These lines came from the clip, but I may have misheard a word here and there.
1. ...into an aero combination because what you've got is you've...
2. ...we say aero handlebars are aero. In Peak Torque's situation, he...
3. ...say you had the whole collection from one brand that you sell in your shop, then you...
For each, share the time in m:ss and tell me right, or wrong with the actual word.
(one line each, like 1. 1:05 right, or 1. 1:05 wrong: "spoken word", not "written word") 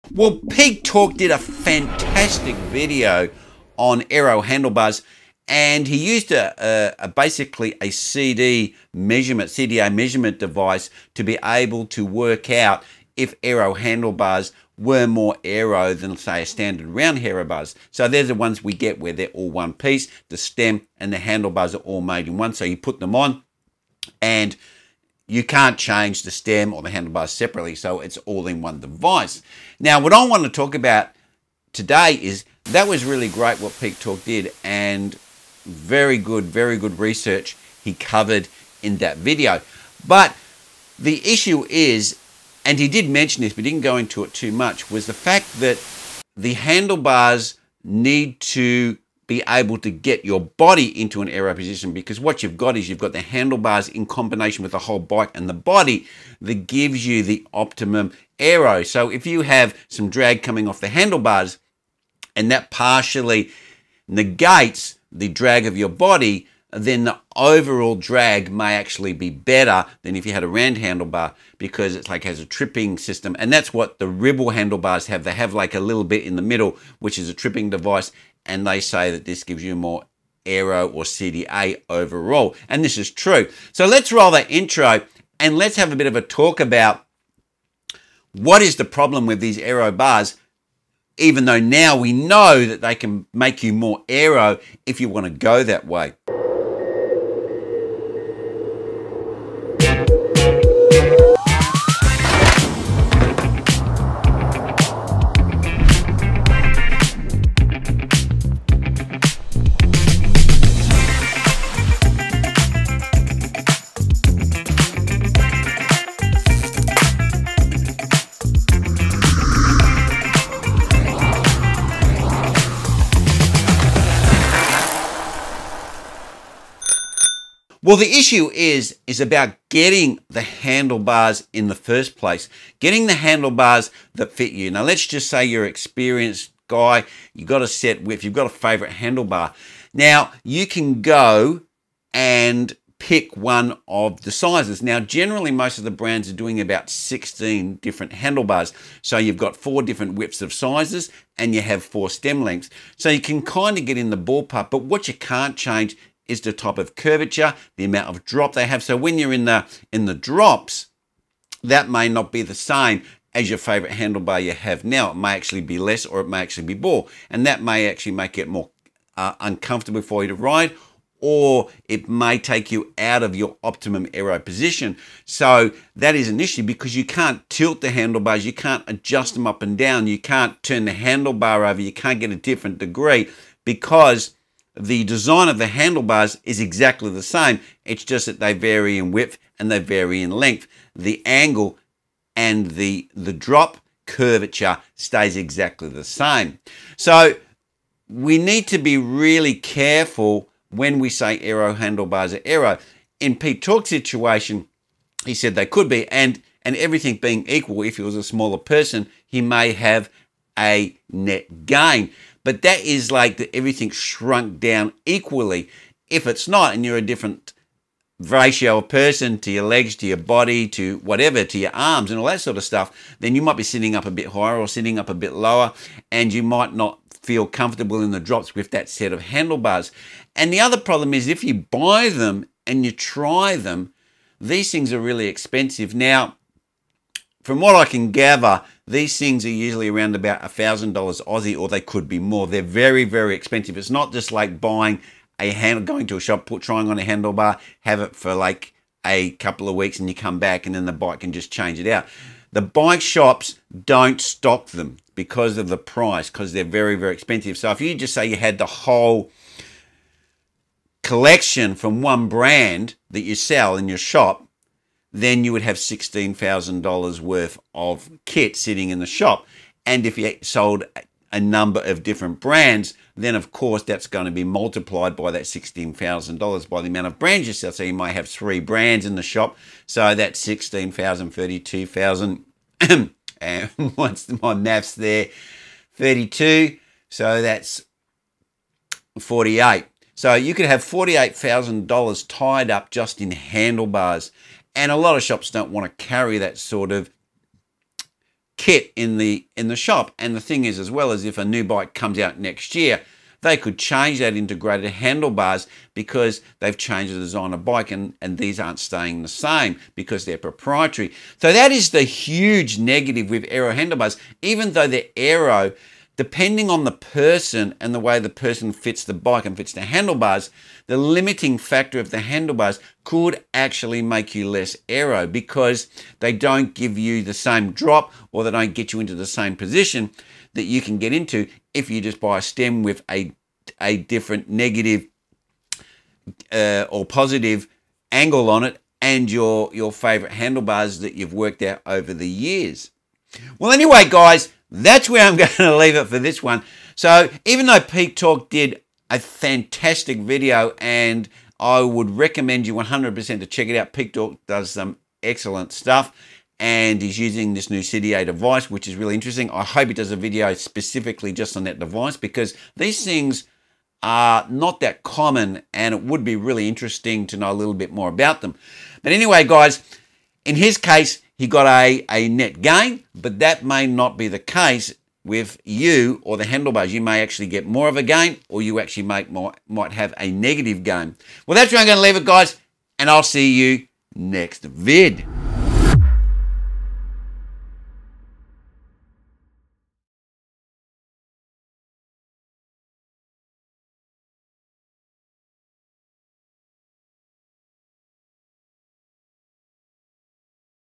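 1. 0:51 wrong: "position", not "combination"
2. 3:20 right
3. 4:18 right.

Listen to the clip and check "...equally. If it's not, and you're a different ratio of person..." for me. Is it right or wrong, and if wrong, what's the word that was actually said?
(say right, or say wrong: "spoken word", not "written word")
right.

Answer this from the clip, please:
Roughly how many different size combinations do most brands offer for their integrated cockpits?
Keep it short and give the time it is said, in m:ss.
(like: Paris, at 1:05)
16, at 2:26.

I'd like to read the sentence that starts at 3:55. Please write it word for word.
Now, from what I can gather, these things are usually around about $1,000 Aussie or they could be more.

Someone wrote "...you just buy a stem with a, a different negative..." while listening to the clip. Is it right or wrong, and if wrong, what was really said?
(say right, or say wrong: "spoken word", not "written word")
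right.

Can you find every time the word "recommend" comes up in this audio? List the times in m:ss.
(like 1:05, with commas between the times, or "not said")
5:52.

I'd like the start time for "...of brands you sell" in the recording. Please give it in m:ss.
4:37.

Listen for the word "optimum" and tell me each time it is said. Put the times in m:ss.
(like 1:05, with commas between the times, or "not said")
0:57, 2:53.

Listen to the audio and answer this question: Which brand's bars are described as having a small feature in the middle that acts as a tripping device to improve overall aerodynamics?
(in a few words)
Ribble.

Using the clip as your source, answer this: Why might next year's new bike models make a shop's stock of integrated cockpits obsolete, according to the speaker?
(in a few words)
They're proprietary.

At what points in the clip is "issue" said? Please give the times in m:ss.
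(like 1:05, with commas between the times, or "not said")
0:41, 2:08, 2:56.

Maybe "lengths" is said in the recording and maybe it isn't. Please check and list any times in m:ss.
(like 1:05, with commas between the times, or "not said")
2:32, 3:10.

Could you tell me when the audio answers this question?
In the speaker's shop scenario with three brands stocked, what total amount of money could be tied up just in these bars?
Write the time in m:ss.
4:50.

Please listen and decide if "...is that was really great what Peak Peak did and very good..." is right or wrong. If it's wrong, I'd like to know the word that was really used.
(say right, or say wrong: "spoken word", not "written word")
wrong: "Torque", not "Peak".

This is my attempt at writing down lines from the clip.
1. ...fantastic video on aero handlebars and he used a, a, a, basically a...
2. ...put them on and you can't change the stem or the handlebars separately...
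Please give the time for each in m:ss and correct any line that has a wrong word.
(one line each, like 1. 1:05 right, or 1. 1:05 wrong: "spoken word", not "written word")
1. 0:01 right
2. 0:22 right.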